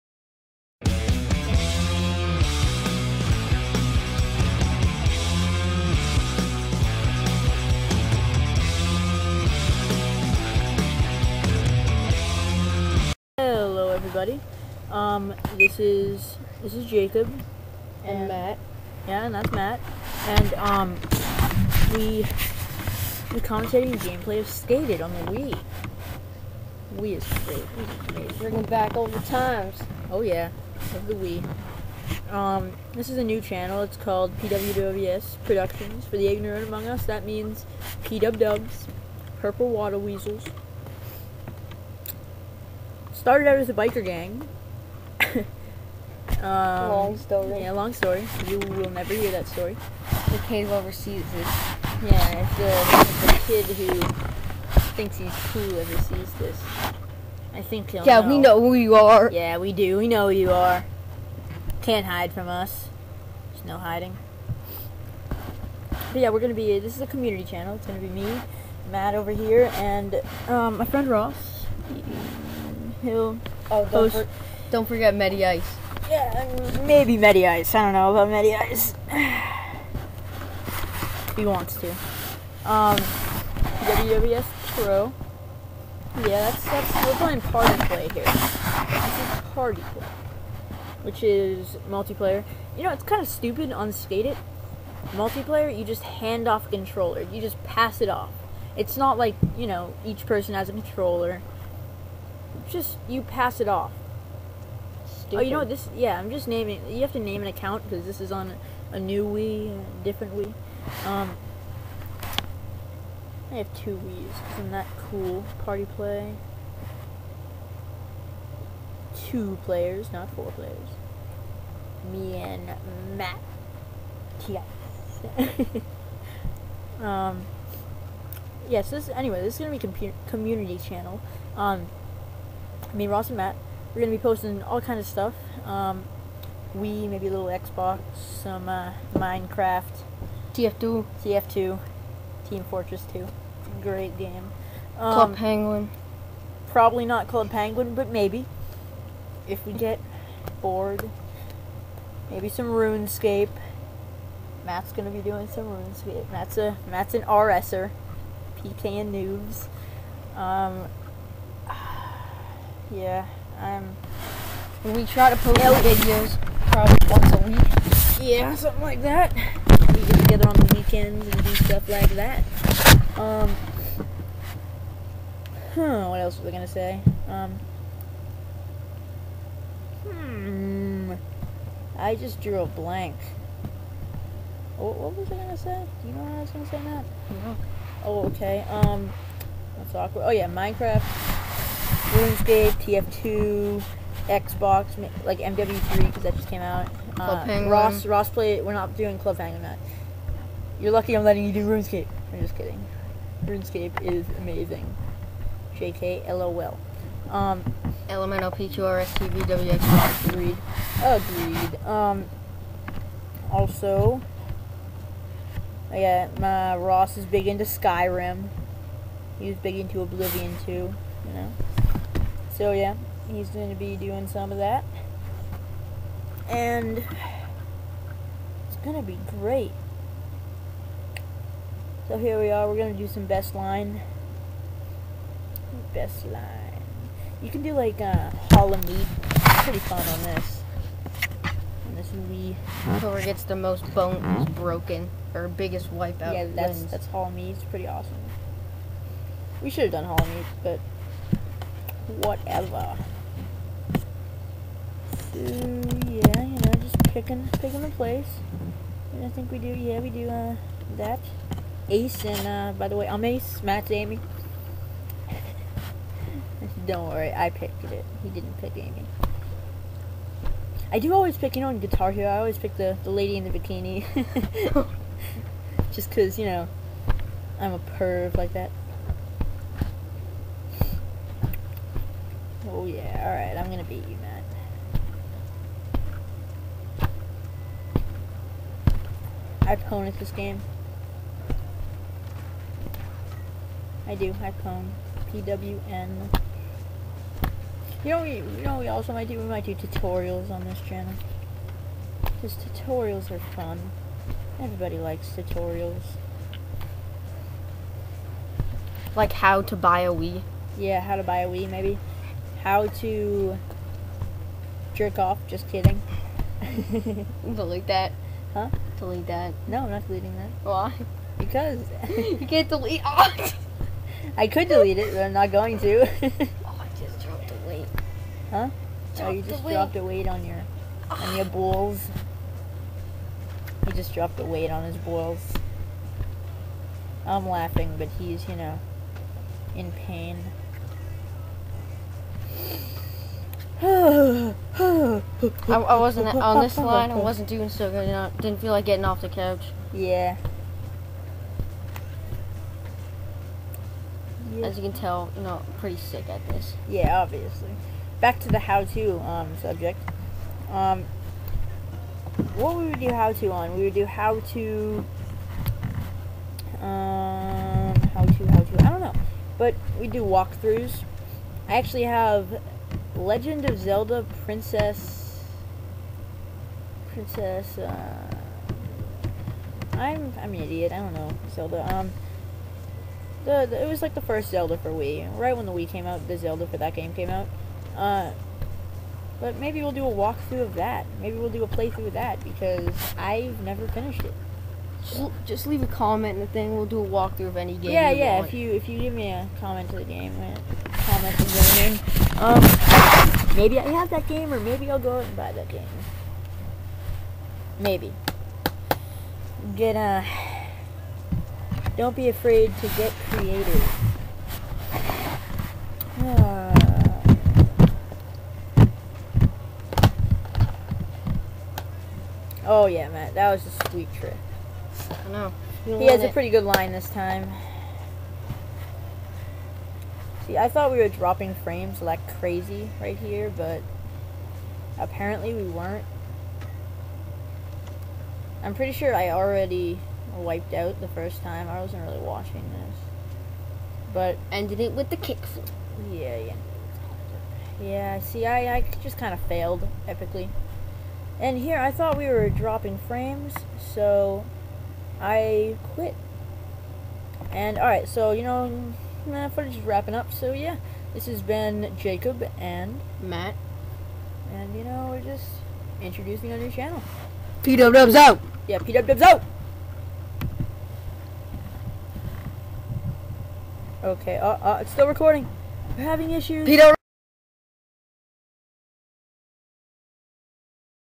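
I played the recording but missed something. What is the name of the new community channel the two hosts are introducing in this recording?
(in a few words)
PWWS Productions.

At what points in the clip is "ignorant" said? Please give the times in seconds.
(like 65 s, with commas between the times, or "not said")
36 s.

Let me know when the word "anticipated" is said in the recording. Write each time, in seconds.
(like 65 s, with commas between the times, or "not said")
not said.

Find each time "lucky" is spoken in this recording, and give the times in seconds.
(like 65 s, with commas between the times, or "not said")
200 s.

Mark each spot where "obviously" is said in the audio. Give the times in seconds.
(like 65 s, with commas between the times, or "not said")
357 s.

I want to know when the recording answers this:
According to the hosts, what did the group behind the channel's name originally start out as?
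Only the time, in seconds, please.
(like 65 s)
43 s.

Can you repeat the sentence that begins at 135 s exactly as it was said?
Um, we maybe a little Xbox, some uh, Minecraft, TF2, TF2, Team Fortress 2.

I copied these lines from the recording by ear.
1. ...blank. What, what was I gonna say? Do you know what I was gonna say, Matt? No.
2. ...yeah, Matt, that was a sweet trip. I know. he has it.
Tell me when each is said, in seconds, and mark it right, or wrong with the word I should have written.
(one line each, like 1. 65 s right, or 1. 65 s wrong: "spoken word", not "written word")
1. 182 s right
2. 422 s right.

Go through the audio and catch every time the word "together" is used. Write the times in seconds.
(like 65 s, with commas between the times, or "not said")
170 s.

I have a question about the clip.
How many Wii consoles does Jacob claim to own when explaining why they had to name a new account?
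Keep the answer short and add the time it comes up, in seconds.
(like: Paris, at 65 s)
2, at 113 s.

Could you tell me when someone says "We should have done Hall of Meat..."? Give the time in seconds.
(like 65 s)
249 s.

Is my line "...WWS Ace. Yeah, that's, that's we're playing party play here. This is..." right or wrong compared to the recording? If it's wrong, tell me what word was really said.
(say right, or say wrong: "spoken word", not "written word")
wrong: "Pro", not "Ace".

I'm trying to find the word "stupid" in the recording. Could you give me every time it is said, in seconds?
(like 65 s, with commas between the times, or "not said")
93 s, 105 s.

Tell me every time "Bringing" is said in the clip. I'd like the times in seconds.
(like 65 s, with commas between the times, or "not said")
28 s.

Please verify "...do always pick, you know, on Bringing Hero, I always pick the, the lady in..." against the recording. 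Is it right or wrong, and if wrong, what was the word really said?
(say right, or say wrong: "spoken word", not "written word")
wrong: "Guitar", not "Bringing".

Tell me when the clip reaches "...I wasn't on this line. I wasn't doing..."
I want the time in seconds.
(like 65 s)
345 s.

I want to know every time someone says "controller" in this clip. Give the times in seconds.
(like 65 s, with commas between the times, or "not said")
96 s, 100 s.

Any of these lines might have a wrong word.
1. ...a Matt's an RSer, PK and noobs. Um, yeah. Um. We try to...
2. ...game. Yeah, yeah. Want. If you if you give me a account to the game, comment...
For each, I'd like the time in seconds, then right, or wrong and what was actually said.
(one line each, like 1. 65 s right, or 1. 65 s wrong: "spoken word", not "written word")
1. 156 s right
2. 397 s wrong: "comment", not "account".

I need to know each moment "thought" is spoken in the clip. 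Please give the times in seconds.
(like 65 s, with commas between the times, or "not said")
430 s, 451 s.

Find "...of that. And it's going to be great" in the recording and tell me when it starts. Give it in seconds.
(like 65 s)
224 s.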